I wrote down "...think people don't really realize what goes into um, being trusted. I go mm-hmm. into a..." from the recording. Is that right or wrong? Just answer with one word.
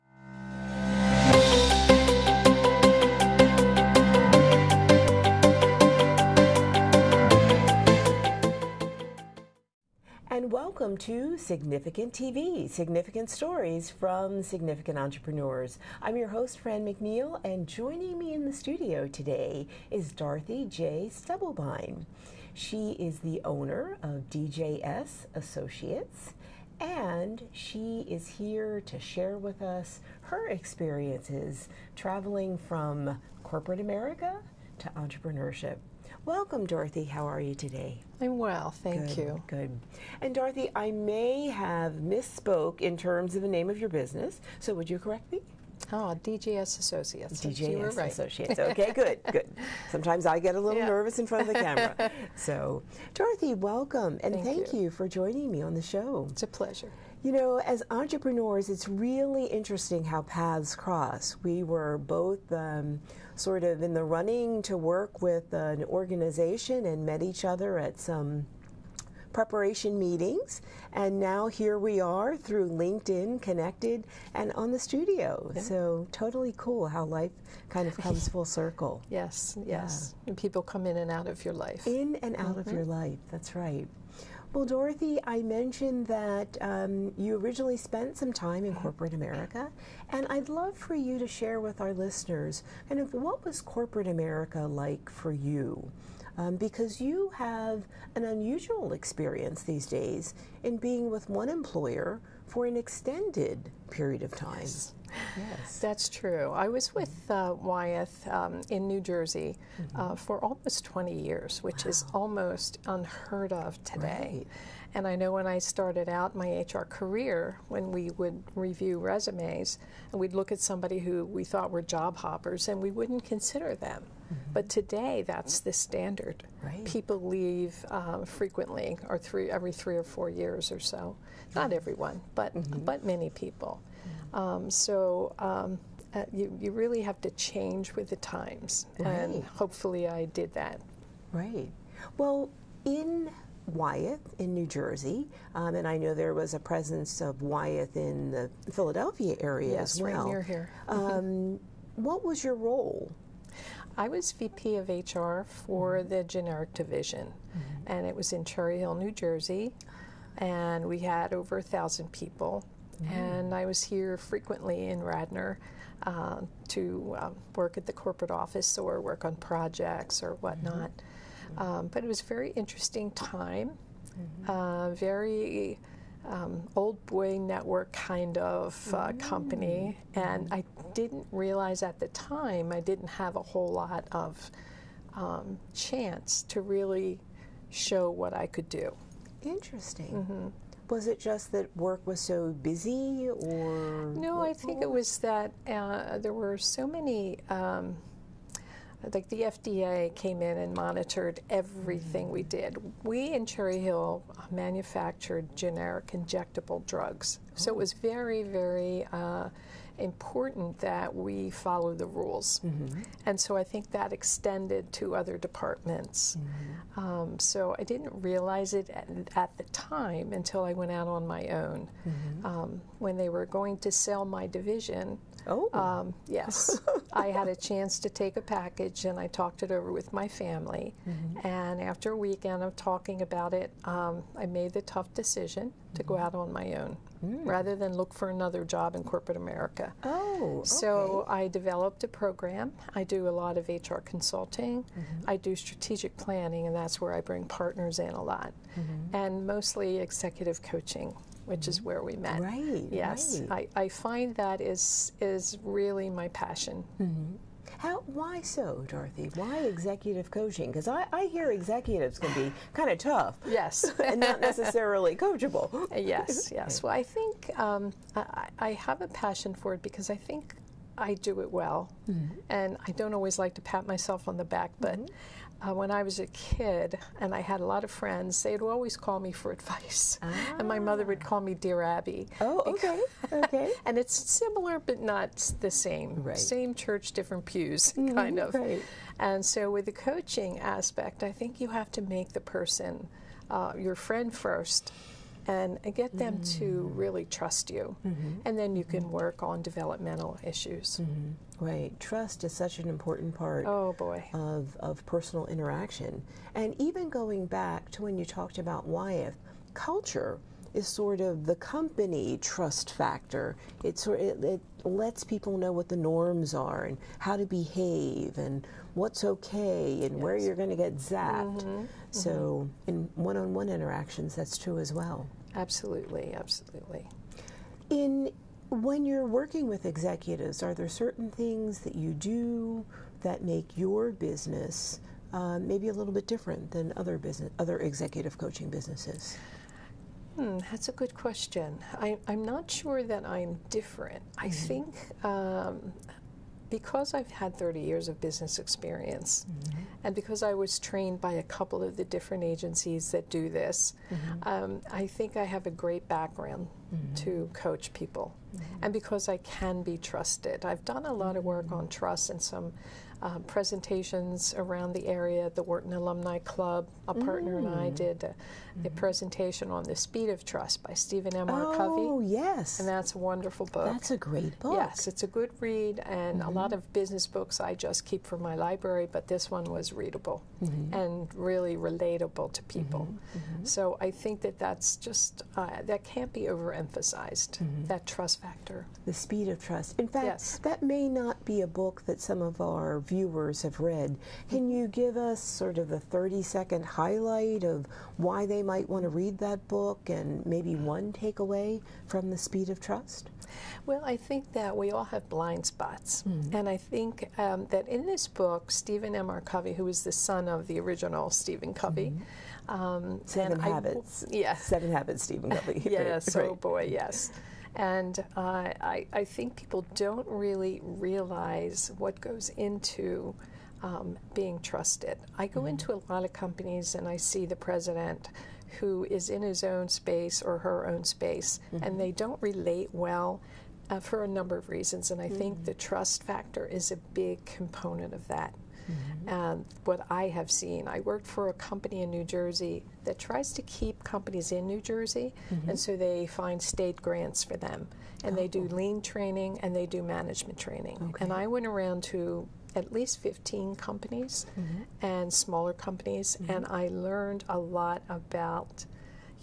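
right.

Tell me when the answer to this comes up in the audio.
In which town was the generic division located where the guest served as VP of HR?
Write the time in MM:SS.
02:38.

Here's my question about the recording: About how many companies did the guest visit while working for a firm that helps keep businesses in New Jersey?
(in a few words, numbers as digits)
15.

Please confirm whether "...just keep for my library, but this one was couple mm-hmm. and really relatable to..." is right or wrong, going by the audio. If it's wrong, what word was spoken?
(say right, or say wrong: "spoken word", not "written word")
wrong: "readable", not "couple".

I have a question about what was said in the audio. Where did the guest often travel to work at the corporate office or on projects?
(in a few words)
Radnor.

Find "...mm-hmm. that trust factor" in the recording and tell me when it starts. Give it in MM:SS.
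06:27.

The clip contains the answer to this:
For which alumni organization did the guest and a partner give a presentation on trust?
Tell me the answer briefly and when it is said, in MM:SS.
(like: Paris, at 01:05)
The Wharton Alumni Club, at 06:05.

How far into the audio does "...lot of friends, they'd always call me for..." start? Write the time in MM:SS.
04:37.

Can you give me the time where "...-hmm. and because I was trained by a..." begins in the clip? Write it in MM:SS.
05:49.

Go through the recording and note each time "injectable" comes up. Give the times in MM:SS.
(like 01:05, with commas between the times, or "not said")
03:26.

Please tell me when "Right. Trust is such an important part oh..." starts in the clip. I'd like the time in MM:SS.
05:01.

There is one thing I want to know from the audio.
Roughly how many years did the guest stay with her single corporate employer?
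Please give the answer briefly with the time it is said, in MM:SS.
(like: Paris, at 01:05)
20, at 01:50.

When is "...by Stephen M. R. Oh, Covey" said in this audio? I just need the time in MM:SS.
06:10.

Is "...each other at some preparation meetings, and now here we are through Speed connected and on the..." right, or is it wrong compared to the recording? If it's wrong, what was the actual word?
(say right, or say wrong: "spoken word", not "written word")
wrong: "LinkedIn", not "Speed".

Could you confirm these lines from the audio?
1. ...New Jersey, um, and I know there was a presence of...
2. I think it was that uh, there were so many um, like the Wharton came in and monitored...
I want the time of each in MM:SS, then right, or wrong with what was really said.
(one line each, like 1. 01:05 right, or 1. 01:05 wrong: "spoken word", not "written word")
1. 02:24 right
2. 03:14 wrong: "FDA", not "Wharton".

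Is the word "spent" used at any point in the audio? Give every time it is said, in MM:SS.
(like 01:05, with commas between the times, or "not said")
01:27.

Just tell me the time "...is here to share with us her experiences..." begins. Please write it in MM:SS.
00:28.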